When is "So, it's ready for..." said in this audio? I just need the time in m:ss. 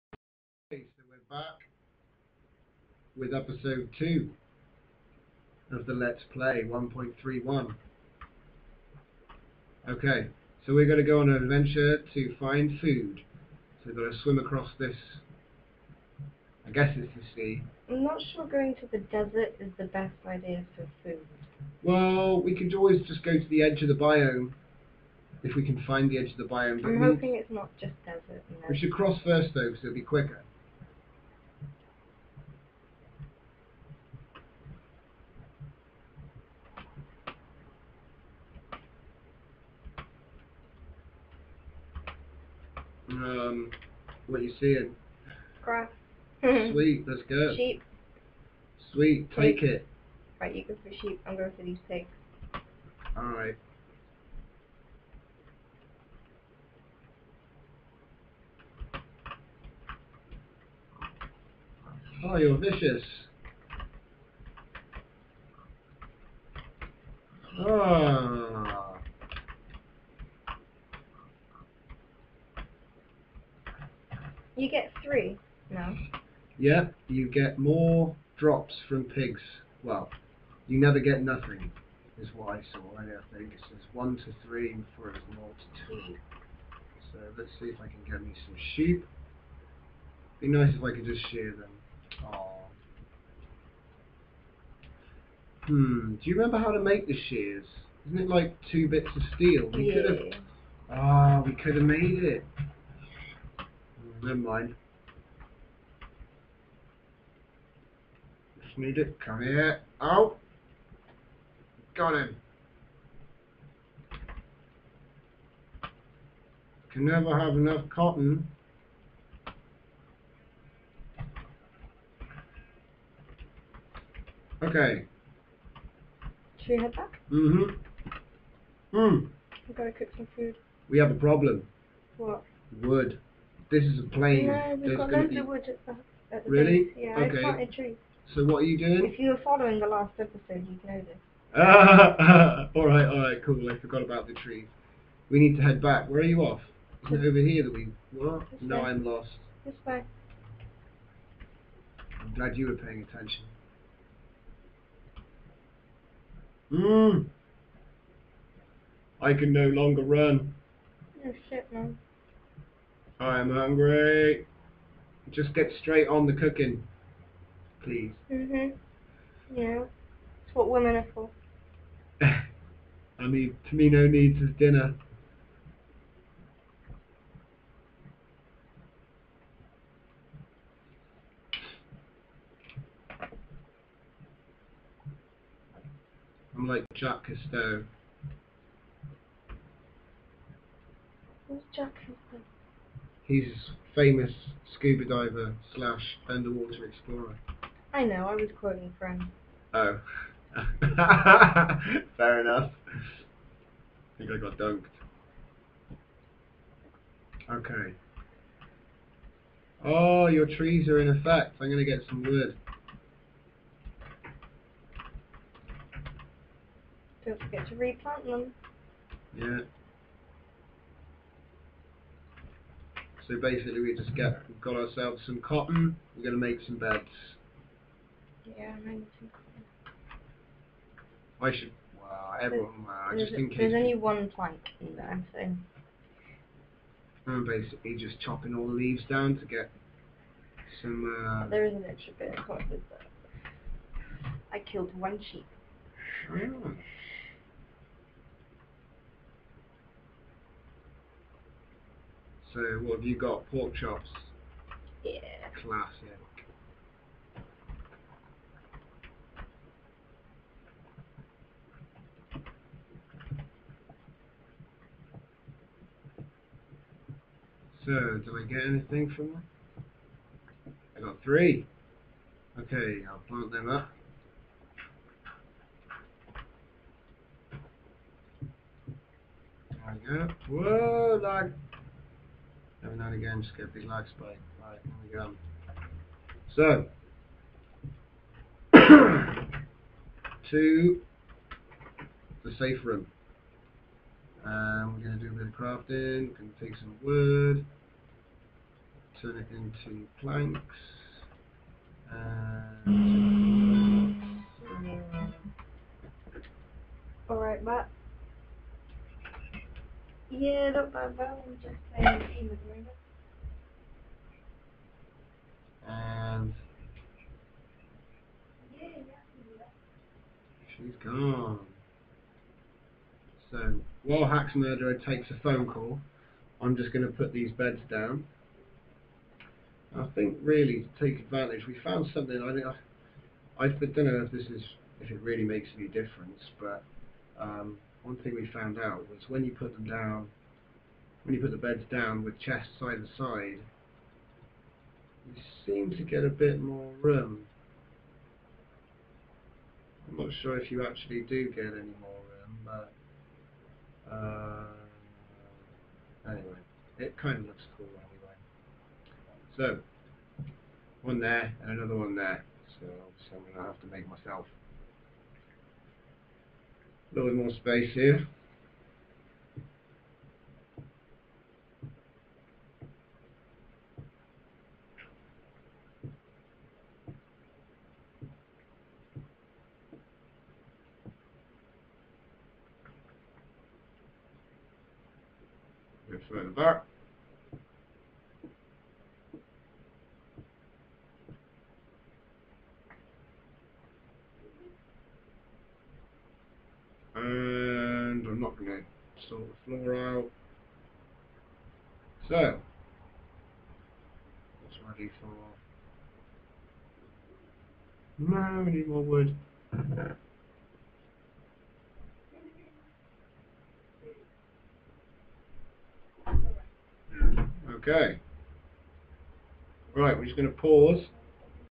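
6:42.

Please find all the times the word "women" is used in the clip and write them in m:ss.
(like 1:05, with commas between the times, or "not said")
2:50.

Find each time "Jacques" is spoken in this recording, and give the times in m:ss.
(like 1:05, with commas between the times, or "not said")
3:06, 3:11.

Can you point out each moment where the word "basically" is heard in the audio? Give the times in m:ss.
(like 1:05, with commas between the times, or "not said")
3:43, 3:57.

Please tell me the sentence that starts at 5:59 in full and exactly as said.
So, one there and another one there.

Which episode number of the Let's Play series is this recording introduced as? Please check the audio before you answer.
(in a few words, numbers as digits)
2.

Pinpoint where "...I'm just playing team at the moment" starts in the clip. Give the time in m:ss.
5:11.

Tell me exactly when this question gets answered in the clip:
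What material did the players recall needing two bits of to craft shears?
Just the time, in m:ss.
1:39.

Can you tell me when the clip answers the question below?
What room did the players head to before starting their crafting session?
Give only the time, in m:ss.
4:52.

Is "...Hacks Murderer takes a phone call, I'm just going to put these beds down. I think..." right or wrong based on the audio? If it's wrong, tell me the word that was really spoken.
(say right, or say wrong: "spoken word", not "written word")
right.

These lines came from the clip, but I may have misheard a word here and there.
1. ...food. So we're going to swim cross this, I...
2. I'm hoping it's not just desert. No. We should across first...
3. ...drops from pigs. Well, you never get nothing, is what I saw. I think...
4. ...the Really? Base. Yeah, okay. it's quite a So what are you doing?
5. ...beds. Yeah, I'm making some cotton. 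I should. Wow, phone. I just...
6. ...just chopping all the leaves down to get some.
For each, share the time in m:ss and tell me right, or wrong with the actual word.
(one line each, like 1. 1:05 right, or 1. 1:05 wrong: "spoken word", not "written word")
1. 0:12 wrong: "across", not "cross"
2. 0:26 wrong: "cross", not "across"
3. 1:18 right
4. 2:16 right
5. 3:46 wrong: "everyone", not "phone"
6. 3:57 right.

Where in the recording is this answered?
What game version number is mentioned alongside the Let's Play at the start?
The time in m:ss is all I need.
0:06.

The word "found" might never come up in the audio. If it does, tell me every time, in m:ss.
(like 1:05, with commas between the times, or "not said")
5:31, 5:38.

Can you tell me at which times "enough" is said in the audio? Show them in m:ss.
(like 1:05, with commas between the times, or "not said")
1:57, 3:22.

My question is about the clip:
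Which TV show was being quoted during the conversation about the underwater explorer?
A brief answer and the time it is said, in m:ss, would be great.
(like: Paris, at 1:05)
Friends, at 3:18.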